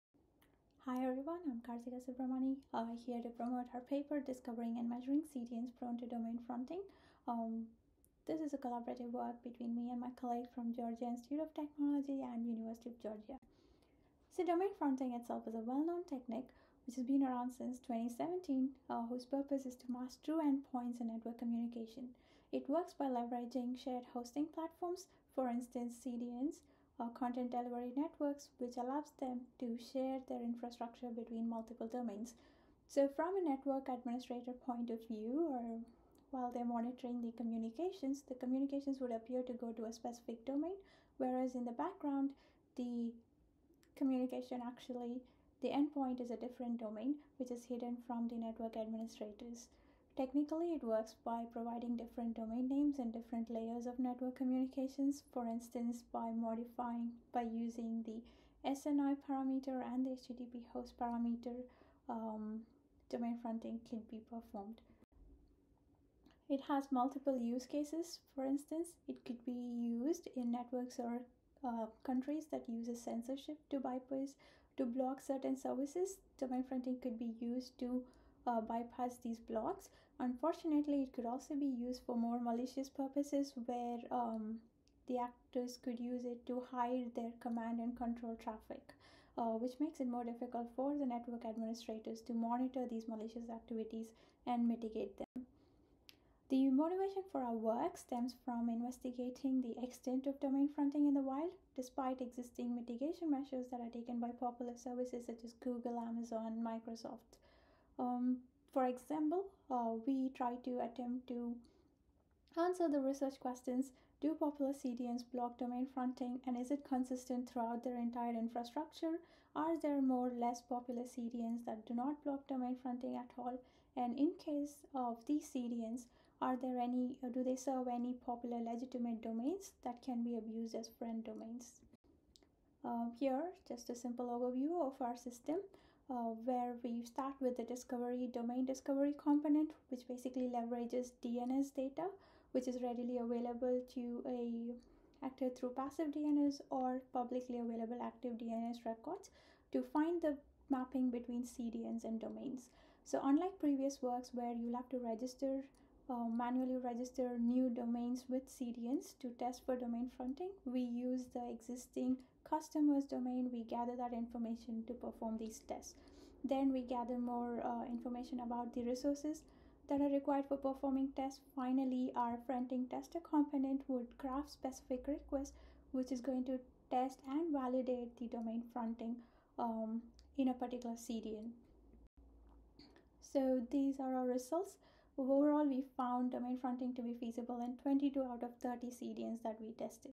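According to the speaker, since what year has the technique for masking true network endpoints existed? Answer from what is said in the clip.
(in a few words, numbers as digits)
2017.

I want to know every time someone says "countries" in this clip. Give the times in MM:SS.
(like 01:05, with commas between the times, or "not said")
01:12.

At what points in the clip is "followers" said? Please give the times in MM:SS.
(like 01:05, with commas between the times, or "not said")
not said.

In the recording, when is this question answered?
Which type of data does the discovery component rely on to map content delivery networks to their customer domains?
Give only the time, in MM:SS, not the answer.
02:21.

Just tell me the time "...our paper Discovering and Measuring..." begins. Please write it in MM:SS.
00:03.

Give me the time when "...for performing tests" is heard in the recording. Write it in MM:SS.
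02:50.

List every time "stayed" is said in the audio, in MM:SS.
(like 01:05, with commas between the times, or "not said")
not said.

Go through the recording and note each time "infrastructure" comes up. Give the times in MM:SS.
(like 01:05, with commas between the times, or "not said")
00:30, 01:58.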